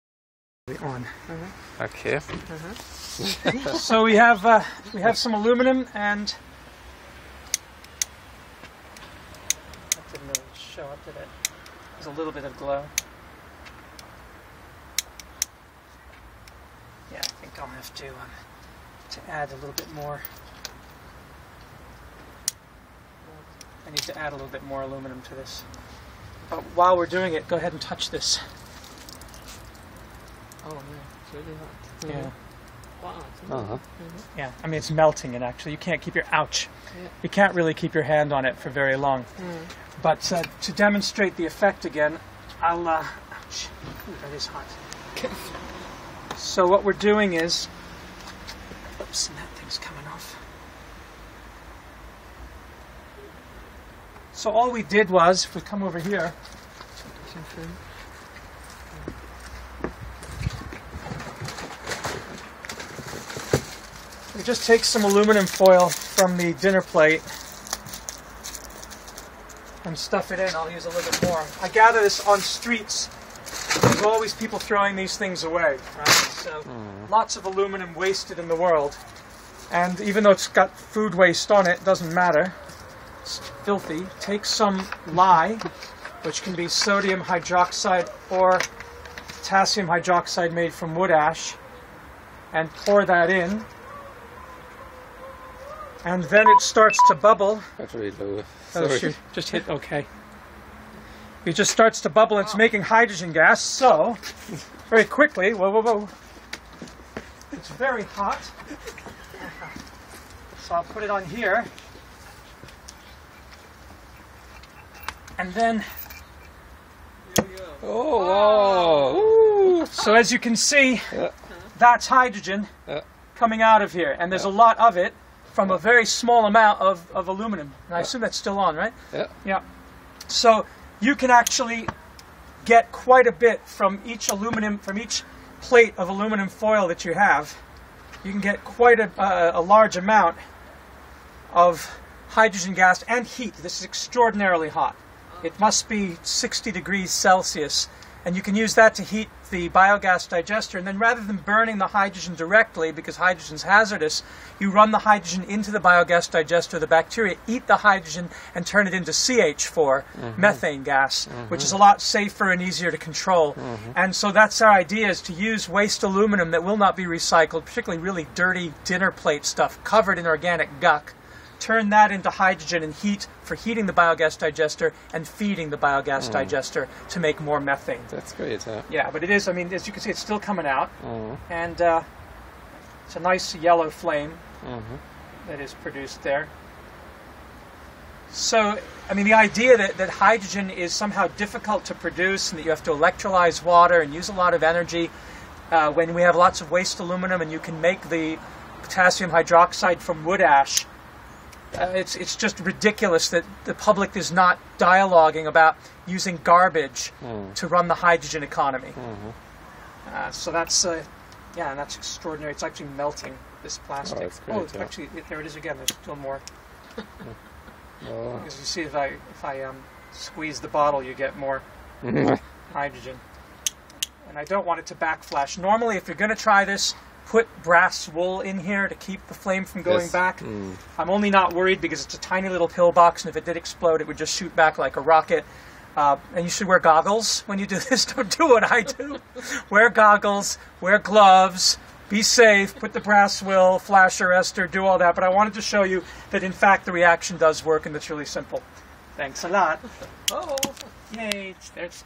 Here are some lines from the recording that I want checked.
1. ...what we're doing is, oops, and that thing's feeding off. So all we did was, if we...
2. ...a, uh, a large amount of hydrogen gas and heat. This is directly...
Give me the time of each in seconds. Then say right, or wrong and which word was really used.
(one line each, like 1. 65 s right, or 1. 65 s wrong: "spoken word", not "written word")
1. 46 s wrong: "coming", not "feeding"
2. 138 s wrong: "extraordinarily", not "directly".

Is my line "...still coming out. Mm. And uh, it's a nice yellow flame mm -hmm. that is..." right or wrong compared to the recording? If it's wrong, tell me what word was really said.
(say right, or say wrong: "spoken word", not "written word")
right.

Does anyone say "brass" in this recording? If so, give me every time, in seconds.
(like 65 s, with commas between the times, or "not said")
227 s, 242 s.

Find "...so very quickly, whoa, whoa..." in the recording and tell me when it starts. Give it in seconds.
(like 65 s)
103 s.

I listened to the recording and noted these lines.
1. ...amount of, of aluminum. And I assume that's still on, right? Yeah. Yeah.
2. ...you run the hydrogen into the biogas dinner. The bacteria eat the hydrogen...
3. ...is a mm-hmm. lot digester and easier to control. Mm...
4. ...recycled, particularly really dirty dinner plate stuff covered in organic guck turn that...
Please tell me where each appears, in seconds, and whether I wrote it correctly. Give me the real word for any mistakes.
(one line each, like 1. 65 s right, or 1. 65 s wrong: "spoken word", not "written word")
1. 126 s right
2. 154 s wrong: "digester", not "dinner"
3. 161 s wrong: "safer", not "digester"
4. 167 s right.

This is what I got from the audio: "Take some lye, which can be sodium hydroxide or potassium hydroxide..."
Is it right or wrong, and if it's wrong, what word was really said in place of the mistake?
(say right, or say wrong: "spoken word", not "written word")
right.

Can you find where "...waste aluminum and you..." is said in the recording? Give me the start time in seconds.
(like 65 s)
196 s.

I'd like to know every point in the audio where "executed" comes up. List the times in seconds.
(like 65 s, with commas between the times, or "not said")
not said.